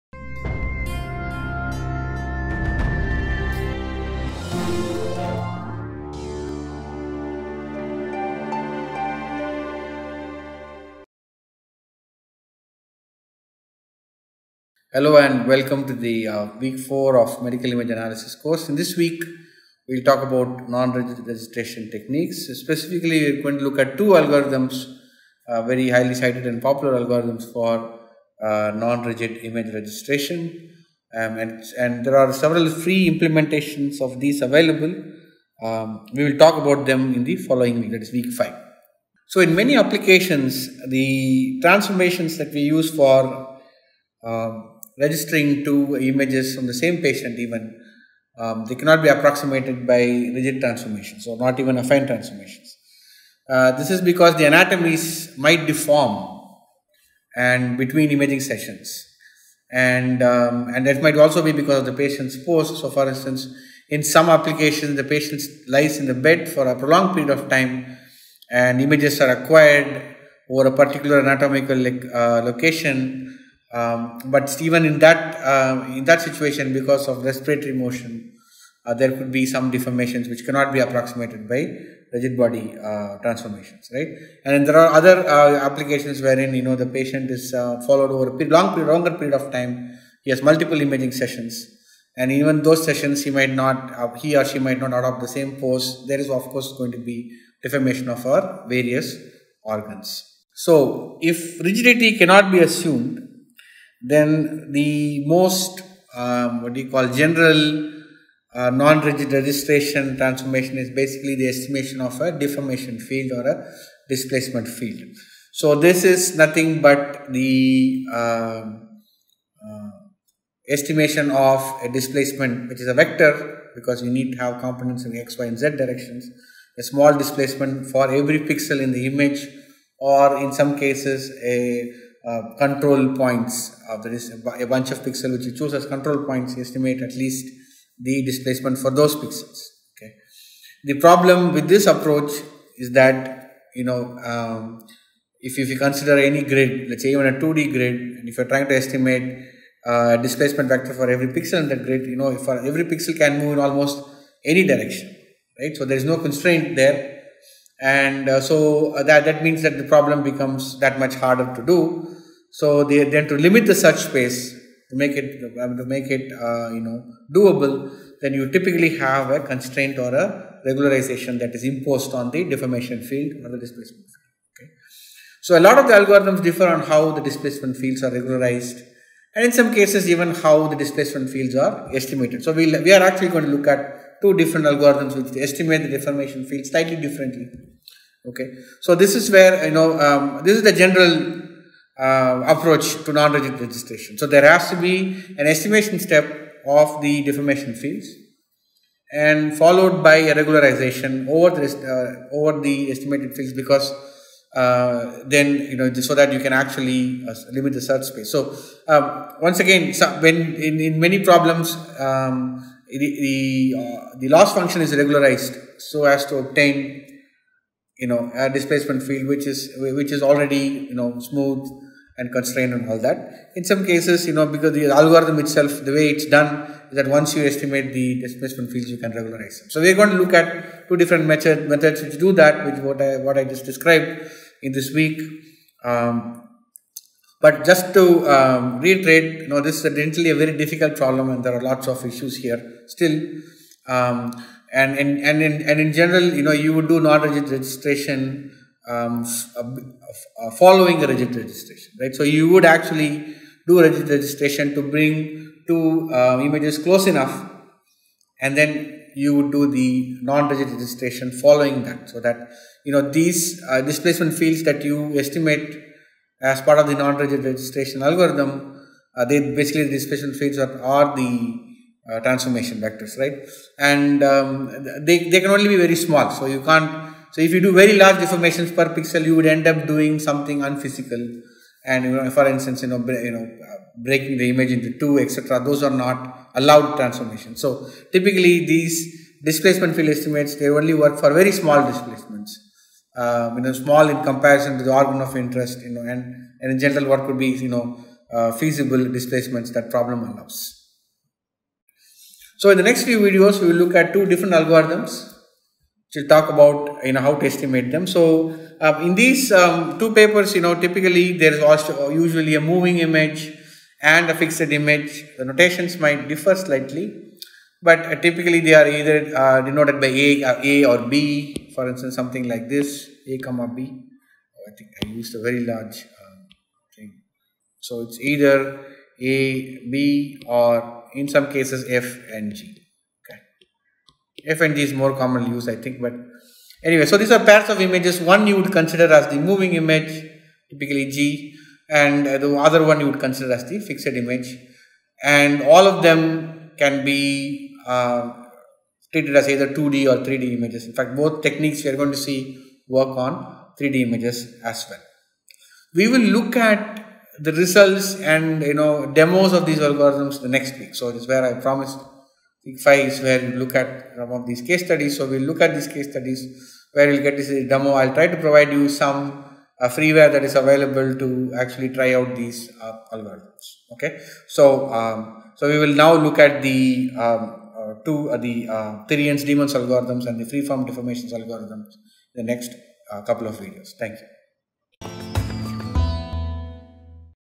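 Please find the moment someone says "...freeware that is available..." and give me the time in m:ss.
6:09.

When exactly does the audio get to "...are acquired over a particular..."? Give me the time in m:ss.
1:09.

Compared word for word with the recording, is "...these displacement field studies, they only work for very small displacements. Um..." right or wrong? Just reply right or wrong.
wrong.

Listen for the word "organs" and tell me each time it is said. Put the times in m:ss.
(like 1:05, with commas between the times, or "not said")
1:39, 4:54.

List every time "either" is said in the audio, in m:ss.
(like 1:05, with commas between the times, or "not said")
5:18, 5:28, 5:49.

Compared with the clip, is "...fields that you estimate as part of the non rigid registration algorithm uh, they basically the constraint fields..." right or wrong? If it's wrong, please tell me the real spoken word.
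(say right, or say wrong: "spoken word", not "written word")
wrong: "displacement", not "constraint".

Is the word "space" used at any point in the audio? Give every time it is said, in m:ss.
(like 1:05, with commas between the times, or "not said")
2:44, 3:28.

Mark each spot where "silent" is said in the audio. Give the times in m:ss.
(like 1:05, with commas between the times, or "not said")
not said.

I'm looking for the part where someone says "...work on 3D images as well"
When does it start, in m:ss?
5:52.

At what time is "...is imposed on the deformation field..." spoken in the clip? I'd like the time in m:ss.
2:51.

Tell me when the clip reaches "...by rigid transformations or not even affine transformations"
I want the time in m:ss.
0:49.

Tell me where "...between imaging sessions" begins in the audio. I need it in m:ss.
0:57.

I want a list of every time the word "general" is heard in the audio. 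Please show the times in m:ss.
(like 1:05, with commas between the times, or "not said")
1:47, 3:10, 4:05, 4:56.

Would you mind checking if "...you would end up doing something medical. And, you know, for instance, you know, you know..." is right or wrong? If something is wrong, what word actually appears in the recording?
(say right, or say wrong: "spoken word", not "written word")
wrong: "unphysical", not "medical".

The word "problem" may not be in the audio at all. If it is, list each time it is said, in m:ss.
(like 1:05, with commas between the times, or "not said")
2:20, 2:39, 3:31, 4:00, 4:59.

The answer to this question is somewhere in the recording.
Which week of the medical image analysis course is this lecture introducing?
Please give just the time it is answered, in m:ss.
0:16.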